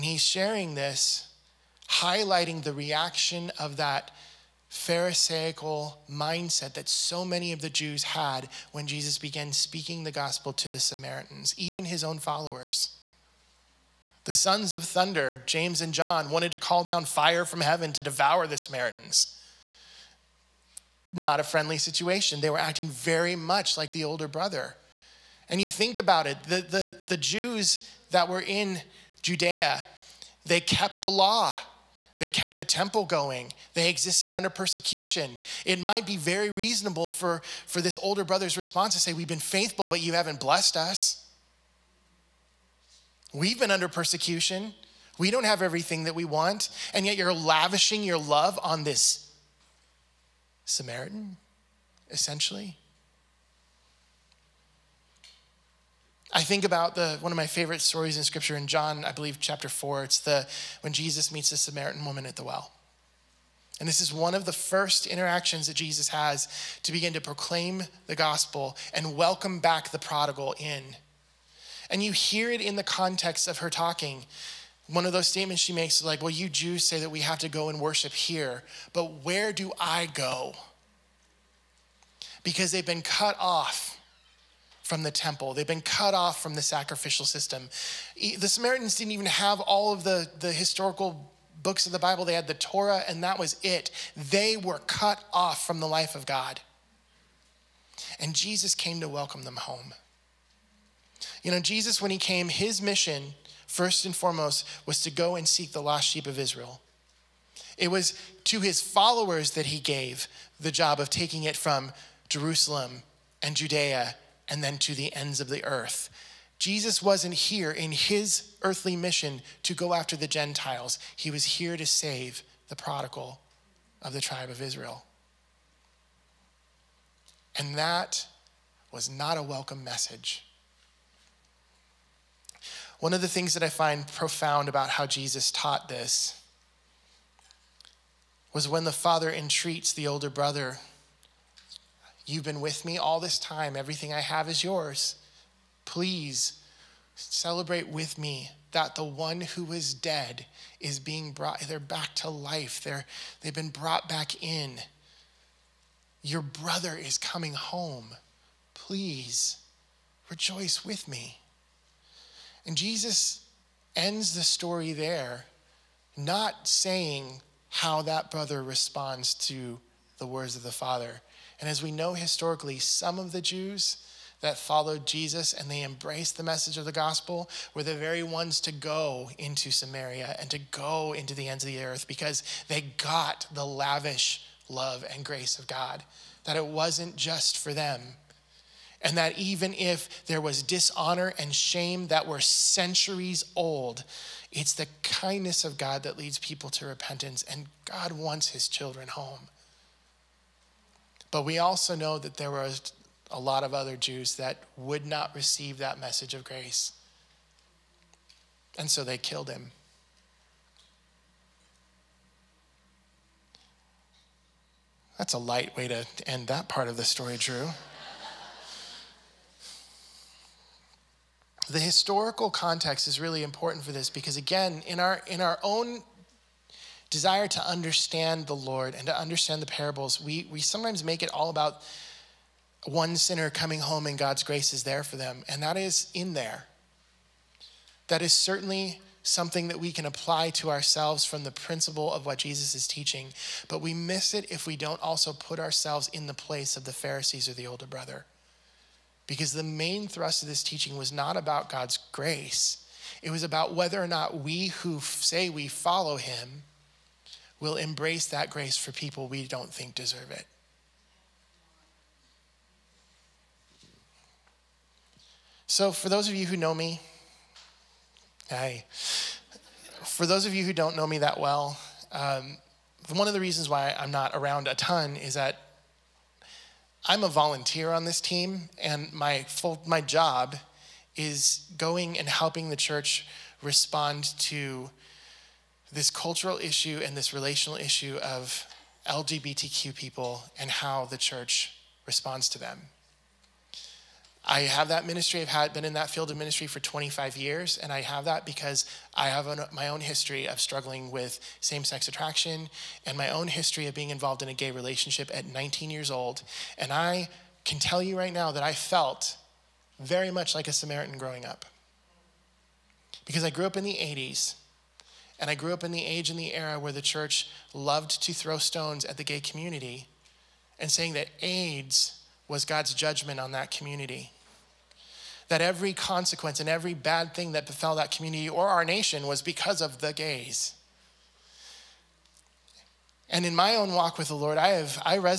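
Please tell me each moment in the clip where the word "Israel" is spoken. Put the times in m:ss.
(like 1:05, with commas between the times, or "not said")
1:46, 2:04.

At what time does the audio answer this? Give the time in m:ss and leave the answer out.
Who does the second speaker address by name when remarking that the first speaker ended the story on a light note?
3:37.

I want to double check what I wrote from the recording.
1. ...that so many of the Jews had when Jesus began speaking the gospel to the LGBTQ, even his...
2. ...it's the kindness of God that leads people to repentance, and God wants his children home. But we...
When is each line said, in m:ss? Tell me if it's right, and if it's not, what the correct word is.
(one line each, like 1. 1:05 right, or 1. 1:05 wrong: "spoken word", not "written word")
1. 0:06 wrong: "Samaritans", not "LGBTQ"
2. 3:14 right.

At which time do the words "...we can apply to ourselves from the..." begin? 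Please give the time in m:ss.
3:59.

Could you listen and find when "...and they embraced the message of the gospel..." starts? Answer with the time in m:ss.
2:55.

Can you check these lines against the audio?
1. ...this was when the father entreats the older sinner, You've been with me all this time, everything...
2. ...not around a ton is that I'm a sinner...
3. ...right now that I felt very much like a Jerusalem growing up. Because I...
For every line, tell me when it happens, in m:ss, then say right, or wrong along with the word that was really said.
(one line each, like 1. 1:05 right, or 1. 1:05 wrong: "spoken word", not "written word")
1. 2:15 wrong: "brother", not "sinner"
2. 4:34 wrong: "volunteer", not "sinner"
3. 5:08 wrong: "Samaritan", not "Jerusalem".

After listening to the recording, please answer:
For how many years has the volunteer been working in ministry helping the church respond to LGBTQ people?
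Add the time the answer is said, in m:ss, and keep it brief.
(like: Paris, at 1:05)
25, at 4:56.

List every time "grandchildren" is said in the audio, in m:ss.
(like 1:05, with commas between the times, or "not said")
not said.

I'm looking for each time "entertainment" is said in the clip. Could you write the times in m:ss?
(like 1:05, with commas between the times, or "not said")
not said.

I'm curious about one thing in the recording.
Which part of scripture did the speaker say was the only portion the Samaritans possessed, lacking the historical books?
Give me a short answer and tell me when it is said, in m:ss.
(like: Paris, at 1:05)
The Torah, at 1:32.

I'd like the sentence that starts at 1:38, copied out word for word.
And Jesus came to welcome them home.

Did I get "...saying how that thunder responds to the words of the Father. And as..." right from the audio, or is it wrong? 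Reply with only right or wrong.
wrong.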